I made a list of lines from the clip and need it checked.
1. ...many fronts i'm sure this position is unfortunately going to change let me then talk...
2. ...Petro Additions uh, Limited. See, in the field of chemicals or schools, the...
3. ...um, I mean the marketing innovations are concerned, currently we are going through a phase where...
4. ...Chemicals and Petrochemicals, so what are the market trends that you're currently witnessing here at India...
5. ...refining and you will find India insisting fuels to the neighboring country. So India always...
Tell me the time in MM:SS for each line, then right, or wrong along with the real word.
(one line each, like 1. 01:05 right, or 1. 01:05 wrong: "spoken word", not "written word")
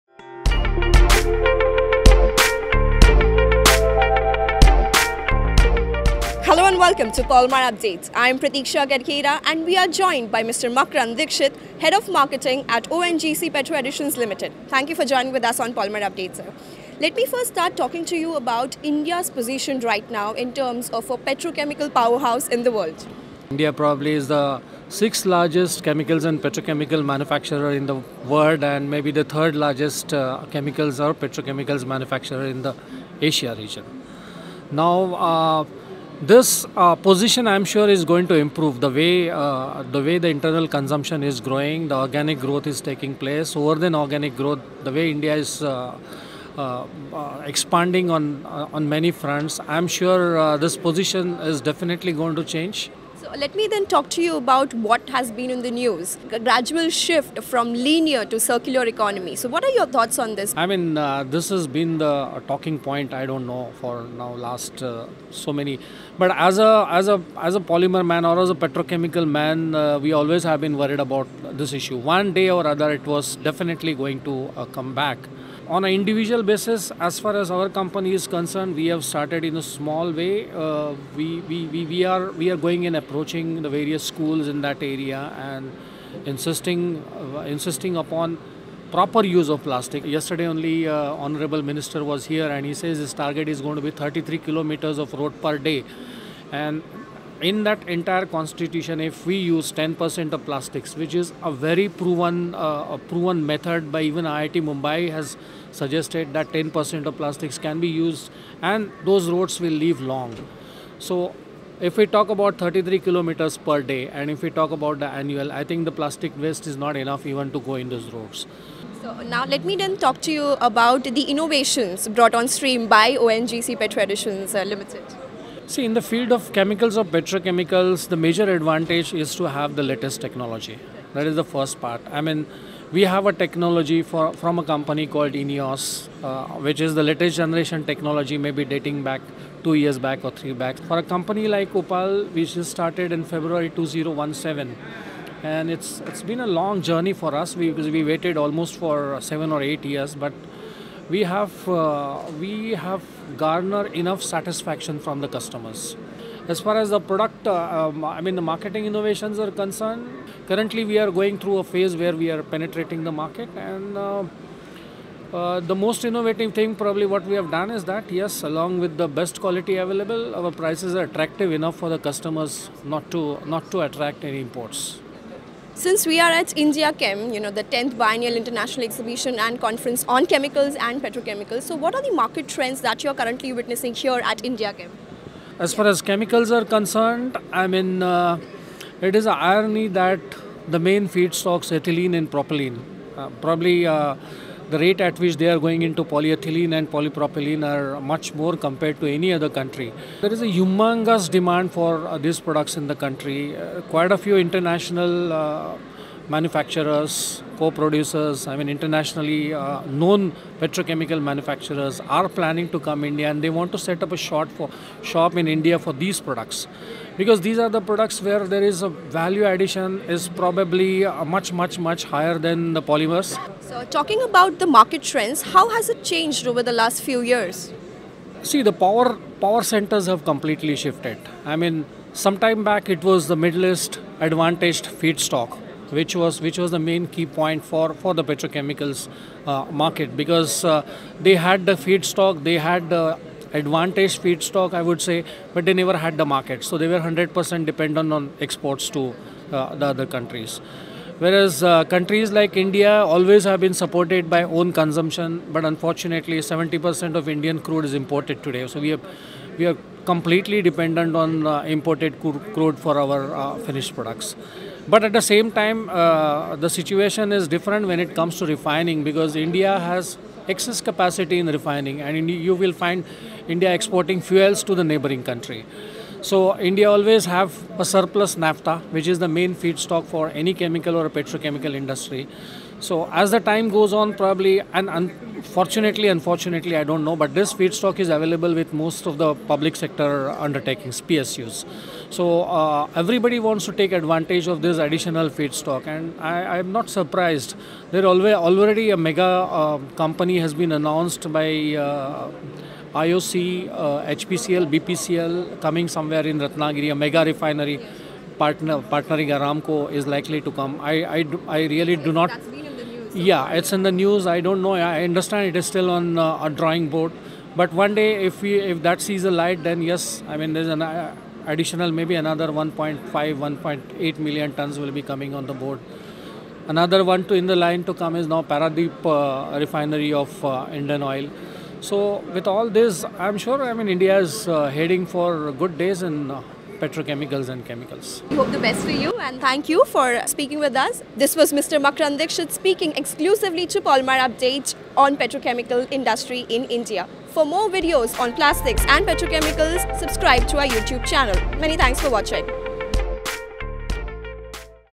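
1. 00:48 wrong: "definitely", not "unfortunately"
2. 02:03 wrong: "petrochemicals", not "schools"
3. 02:37 right
4. 03:00 right
5. 04:31 wrong: "exporting", not "insisting".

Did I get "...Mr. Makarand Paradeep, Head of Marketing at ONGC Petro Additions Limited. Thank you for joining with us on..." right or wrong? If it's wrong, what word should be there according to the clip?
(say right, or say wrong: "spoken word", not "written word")
wrong: "Dixit", not "Paradeep".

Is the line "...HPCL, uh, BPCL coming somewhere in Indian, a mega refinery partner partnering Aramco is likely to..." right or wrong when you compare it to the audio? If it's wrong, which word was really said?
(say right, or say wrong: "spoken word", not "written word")
wrong: "Ratnagiri", not "Indian".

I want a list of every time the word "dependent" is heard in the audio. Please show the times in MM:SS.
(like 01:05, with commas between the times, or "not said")
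04:07, 04:20.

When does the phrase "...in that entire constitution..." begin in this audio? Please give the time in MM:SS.
01:37.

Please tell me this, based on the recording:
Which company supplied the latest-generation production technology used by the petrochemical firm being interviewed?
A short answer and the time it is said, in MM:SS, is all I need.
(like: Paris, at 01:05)
INEOS, at 02:15.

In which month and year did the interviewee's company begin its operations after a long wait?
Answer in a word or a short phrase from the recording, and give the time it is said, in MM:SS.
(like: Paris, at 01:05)
February 2017, at 02:23.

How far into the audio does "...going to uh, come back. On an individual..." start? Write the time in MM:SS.
01:13.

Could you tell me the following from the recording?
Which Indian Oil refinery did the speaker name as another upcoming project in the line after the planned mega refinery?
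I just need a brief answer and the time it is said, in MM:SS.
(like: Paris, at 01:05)
Paradeep, at 05:28.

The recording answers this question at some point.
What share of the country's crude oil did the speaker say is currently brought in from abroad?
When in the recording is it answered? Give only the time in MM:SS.
04:16.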